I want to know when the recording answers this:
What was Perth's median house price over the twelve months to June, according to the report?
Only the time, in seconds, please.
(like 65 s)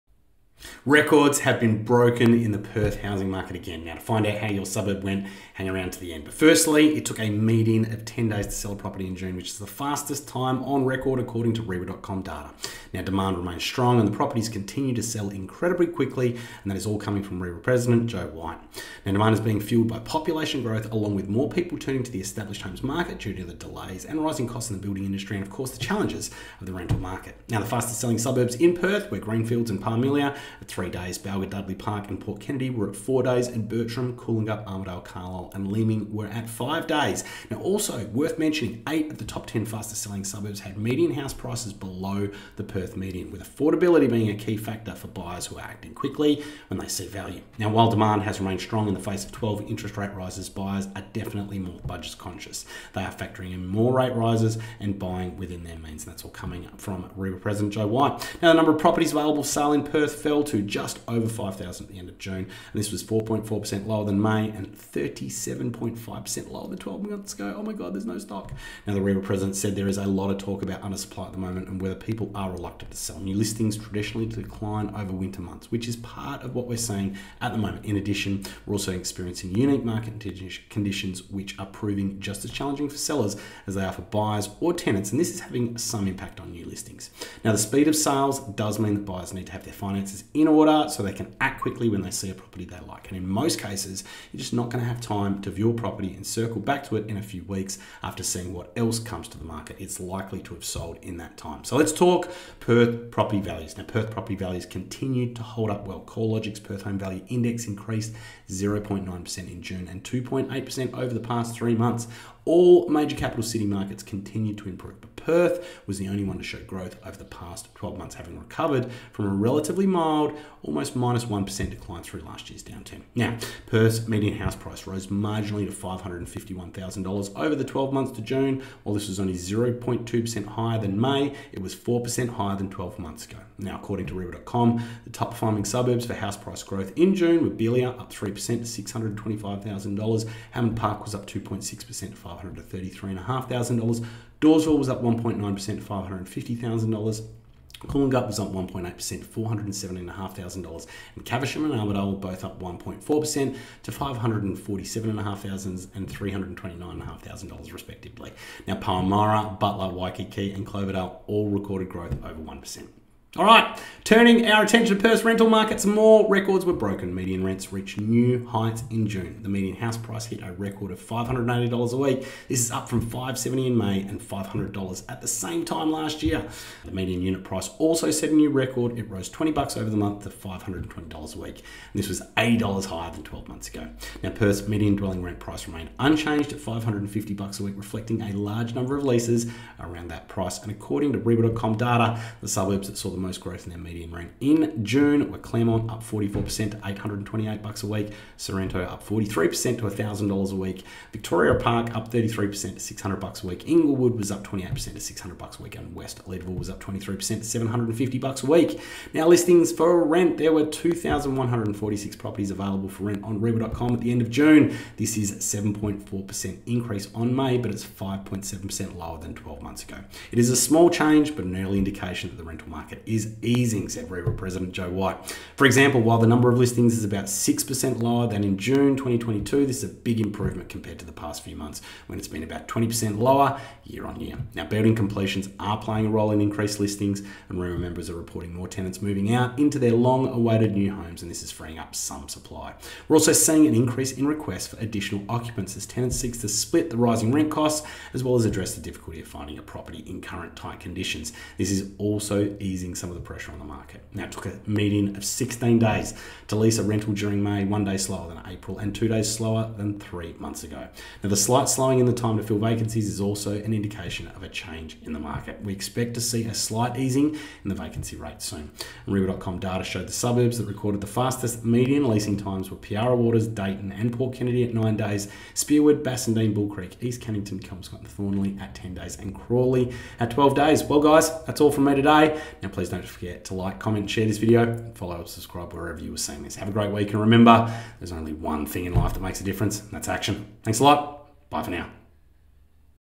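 125 s.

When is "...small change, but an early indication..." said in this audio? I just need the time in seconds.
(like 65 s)
220 s.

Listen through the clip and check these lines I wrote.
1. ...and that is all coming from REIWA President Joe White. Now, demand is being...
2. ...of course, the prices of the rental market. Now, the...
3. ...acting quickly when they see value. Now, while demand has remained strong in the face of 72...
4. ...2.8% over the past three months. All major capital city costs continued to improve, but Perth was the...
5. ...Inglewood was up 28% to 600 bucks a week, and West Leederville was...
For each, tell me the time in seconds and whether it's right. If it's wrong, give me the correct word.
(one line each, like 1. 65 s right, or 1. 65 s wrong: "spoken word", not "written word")
1. 16 s right
2. 25 s wrong: "challenges", not "prices"
3. 45 s wrong: "12", not "72"
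4. 110 s wrong: "markets", not "costs"
5. 203 s right.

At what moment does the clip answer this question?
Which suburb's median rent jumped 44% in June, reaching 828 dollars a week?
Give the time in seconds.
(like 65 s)
195 s.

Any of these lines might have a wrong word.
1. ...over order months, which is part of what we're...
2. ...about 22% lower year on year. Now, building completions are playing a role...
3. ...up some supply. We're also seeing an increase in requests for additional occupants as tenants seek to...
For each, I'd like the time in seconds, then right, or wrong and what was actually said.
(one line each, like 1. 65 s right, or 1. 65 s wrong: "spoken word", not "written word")
1. 74 s wrong: "winter", not "order"
2. 232 s wrong: "20", not "22"
3. 241 s right.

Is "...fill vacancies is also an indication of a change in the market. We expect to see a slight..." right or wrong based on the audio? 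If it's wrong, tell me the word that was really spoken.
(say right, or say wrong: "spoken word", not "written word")
right.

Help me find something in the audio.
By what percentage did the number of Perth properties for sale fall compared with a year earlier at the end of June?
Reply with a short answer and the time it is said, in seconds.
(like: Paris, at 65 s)
37.5%, at 64 s.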